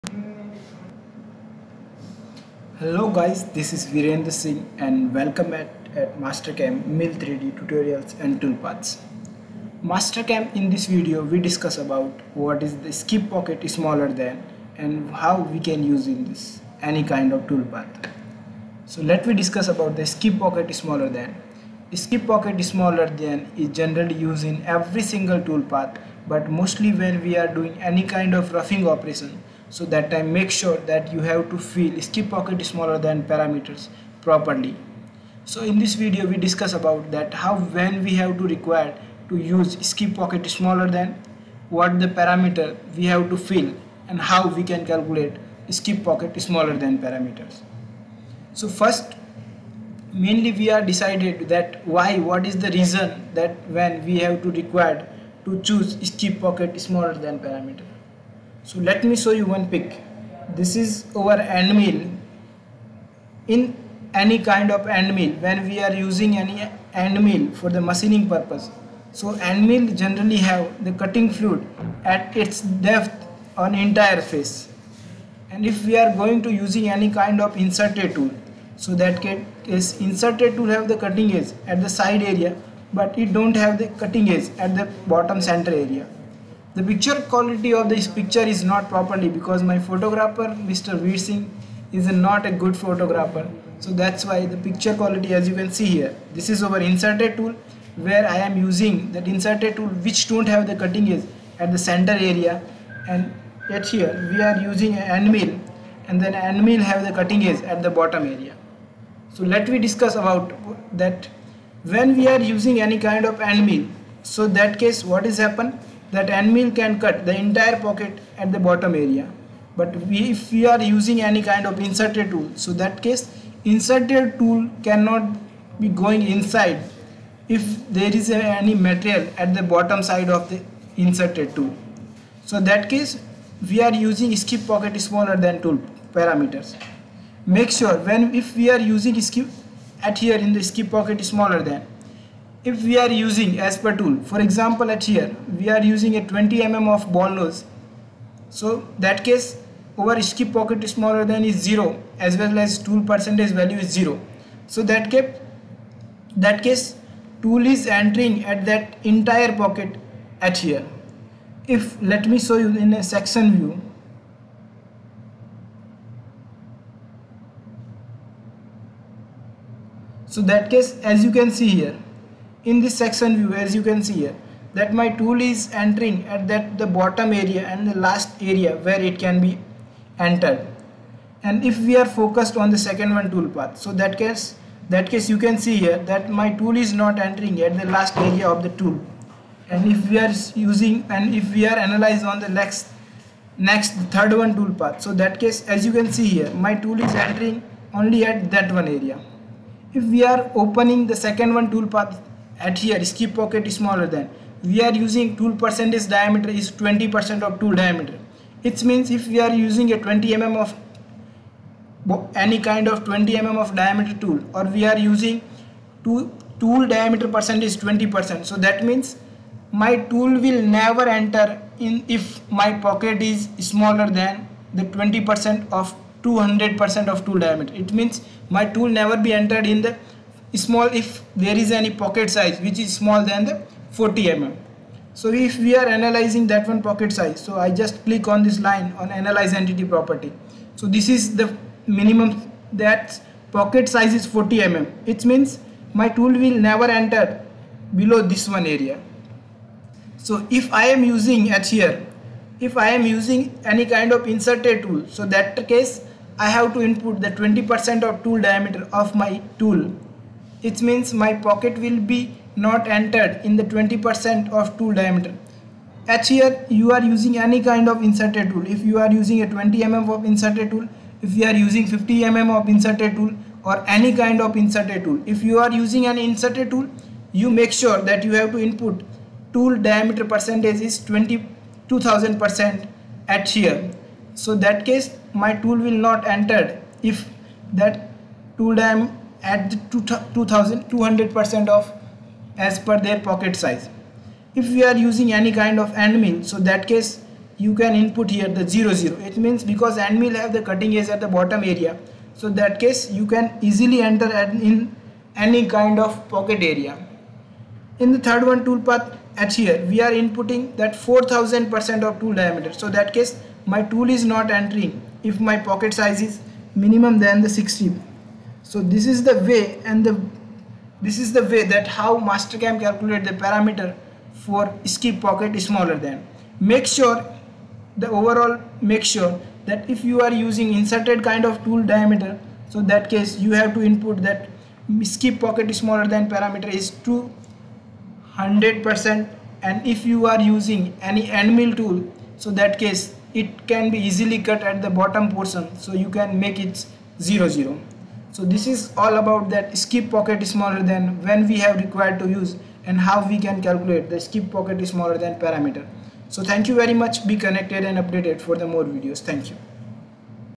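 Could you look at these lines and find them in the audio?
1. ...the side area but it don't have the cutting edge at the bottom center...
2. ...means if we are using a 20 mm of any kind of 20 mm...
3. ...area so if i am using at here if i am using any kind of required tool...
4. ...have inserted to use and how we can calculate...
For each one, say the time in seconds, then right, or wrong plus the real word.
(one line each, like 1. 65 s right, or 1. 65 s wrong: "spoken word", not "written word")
1. 81 s right
2. 208 s right
3. 248 s wrong: "inserted", not "required"
4. 351 s wrong: "required", not "inserted".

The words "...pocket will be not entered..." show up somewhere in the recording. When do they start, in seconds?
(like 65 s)
261 s.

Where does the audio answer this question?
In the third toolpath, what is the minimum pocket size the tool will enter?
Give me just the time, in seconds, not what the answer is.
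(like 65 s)
317 s.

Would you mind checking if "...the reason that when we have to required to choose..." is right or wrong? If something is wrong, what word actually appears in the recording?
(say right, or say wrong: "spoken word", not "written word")
right.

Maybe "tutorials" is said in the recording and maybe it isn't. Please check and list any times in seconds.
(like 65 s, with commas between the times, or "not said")
7 s.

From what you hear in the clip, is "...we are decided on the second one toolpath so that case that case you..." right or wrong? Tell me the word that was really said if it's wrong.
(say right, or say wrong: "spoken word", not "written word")
wrong: "focused", not "decided".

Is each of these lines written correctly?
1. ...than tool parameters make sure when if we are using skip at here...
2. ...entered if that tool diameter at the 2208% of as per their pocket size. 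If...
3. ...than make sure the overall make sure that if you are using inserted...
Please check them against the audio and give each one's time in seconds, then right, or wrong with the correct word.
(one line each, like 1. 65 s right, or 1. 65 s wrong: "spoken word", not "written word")
1. 135 s right
2. 286 s wrong: "2200", not "2208"
3. 326 s right.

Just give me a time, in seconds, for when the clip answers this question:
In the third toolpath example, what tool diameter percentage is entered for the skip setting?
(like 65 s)
310 s.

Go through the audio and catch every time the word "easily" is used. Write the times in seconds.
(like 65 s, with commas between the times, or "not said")
303 s, 344 s.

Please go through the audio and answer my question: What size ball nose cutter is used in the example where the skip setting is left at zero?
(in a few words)
20 mm.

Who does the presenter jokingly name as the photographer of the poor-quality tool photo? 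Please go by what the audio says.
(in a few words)
Mr. Singh.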